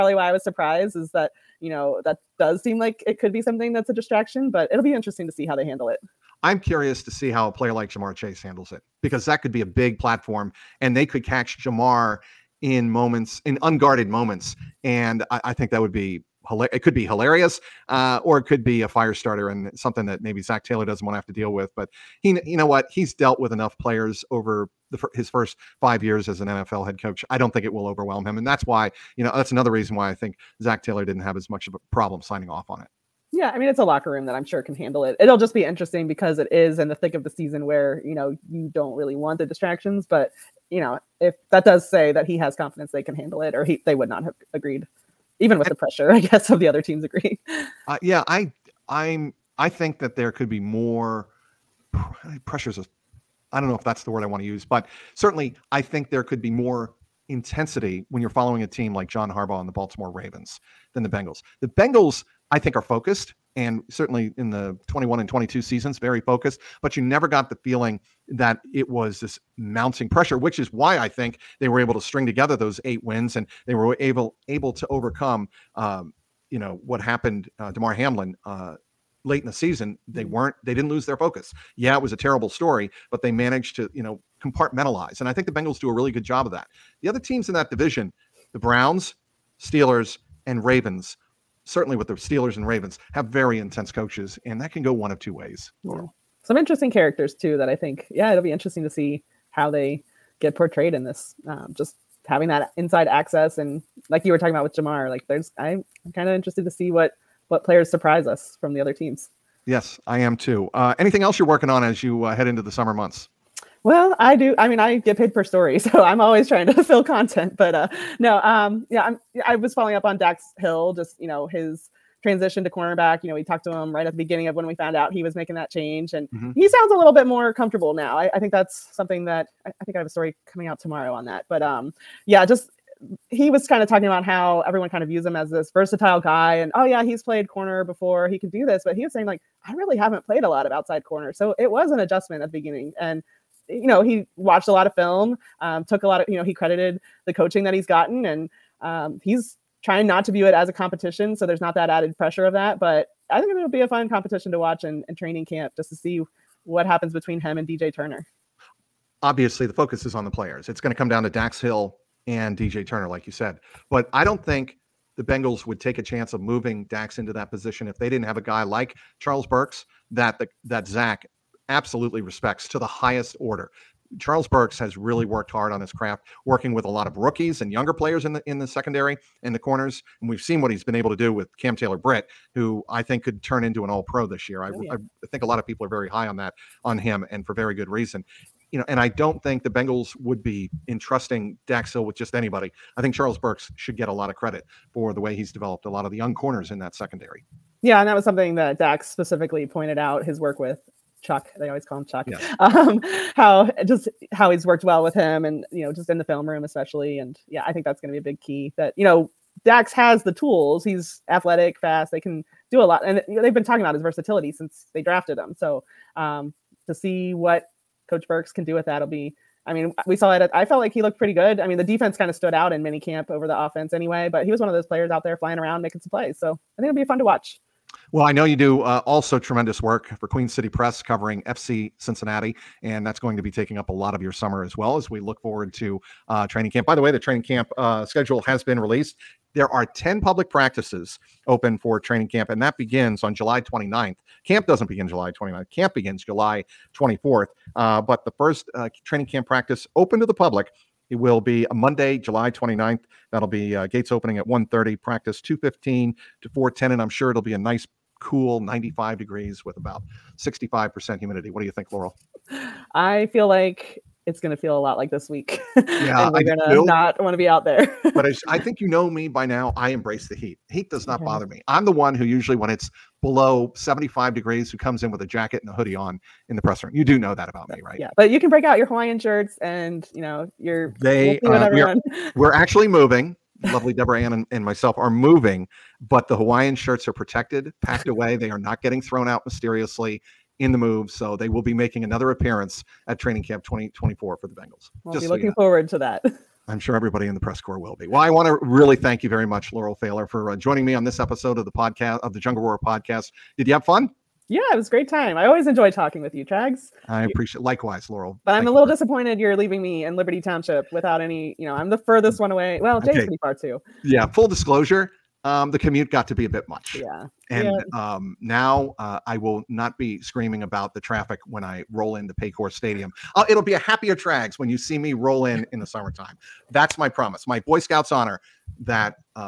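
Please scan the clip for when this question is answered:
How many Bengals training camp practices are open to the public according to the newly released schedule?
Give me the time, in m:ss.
3:59.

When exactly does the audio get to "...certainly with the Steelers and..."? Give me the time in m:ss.
1:31.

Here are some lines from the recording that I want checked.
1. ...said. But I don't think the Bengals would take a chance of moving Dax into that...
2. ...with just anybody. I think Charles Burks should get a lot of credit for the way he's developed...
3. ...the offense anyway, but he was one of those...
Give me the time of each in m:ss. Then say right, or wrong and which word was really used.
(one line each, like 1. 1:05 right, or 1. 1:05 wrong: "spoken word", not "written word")
1. 2:43 right
2. 3:12 right
3. 3:43 right.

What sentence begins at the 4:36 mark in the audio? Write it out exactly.
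You do know that about me, right?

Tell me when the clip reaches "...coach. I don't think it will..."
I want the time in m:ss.
0:27.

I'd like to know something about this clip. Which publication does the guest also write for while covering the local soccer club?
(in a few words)
Queen City Press.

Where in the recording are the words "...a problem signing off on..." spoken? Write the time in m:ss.
0:31.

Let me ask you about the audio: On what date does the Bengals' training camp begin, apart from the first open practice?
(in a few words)
July 24.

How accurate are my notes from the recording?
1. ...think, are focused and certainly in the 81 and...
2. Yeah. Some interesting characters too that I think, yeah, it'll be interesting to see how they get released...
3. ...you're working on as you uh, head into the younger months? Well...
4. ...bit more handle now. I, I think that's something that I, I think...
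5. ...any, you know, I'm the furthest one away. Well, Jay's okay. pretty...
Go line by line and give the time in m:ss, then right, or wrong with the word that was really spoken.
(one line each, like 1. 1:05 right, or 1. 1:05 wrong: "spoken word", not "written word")
1. 1:02 wrong: "21", not "81"
2. 1:35 wrong: "portrayed", not "released"
3. 1:51 wrong: "summer", not "younger"
4. 2:07 wrong: "comfortable", not "handle"
5. 5:11 right.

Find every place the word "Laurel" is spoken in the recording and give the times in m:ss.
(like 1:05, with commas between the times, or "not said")
4:21, 4:59, 5:08.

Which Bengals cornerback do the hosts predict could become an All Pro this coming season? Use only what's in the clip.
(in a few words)
Cam Taylor Britt.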